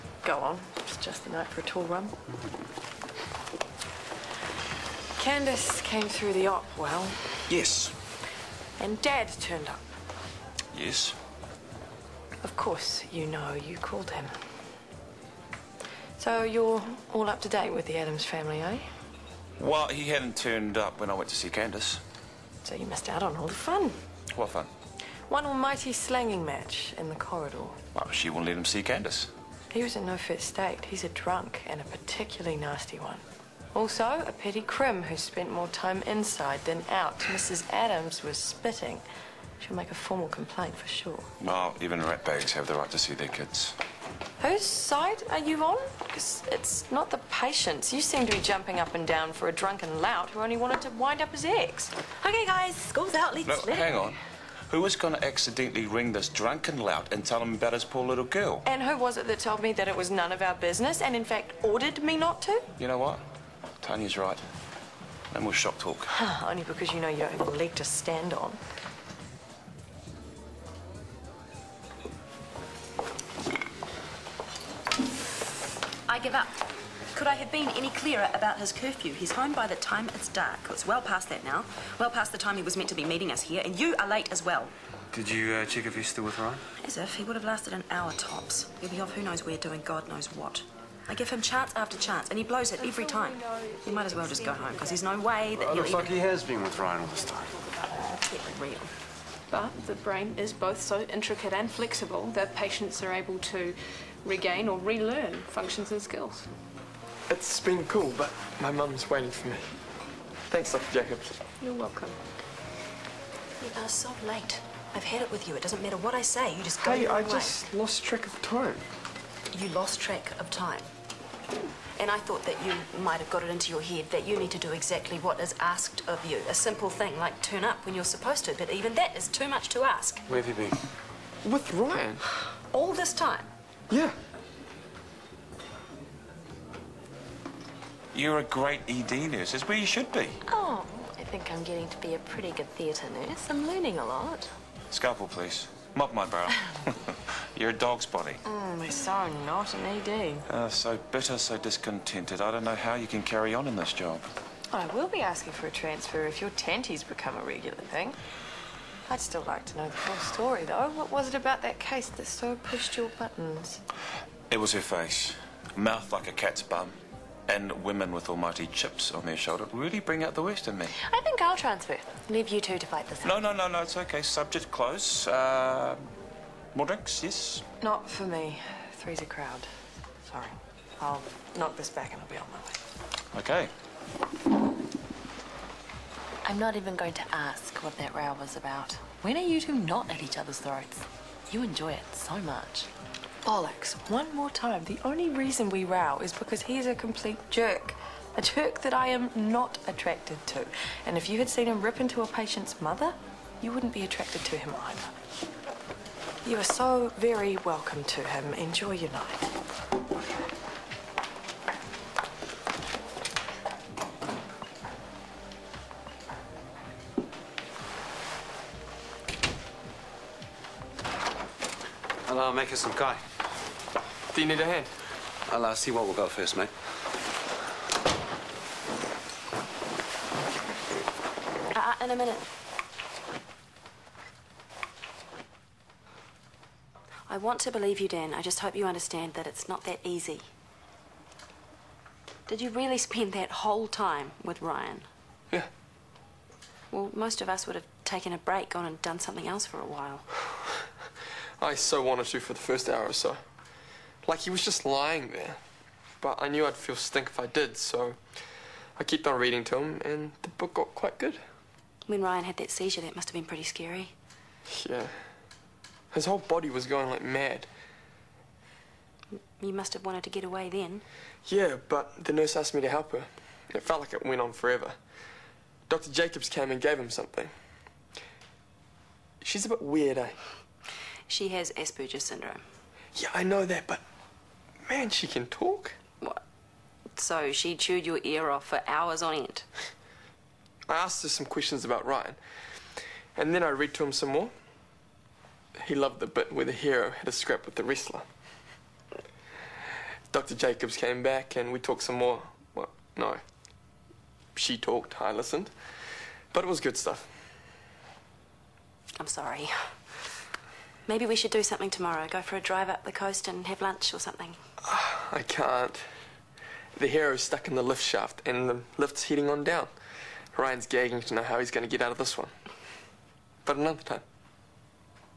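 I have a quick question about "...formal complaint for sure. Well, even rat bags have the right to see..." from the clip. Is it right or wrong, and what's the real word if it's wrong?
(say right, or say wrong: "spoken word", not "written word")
right.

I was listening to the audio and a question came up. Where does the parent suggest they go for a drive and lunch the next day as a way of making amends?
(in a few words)
Up the coast.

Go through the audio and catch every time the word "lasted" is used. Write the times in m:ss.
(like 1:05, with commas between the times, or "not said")
1:27.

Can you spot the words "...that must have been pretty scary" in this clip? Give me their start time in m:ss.
4:22.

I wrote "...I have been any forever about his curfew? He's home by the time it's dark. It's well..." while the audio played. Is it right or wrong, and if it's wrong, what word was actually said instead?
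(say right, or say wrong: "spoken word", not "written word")
wrong: "clearer", not "forever".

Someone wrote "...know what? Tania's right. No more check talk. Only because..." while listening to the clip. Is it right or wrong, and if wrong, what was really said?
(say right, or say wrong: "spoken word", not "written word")
wrong: "shock", not "check".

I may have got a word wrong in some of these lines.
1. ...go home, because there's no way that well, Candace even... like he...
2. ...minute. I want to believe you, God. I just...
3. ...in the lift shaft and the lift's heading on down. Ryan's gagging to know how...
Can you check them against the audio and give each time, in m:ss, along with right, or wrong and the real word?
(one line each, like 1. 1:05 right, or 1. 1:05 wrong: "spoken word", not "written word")
1. 1:34 wrong: "Looks", not "Candace"
2. 3:52 wrong: "Dan", not "God"
3. 5:17 right.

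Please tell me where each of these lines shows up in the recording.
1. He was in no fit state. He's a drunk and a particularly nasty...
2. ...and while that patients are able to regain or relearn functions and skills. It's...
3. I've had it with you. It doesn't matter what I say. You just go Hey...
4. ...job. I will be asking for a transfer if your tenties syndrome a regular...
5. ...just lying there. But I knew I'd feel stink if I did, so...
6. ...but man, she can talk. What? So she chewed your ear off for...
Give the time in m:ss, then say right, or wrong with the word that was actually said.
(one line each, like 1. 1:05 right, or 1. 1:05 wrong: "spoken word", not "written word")
1. 0:29 right
2. 1:41 wrong: "flexible", not "while"
3. 1:54 right
4. 2:33 wrong: "become", not "syndrome"
5. 4:14 right
6. 4:43 right.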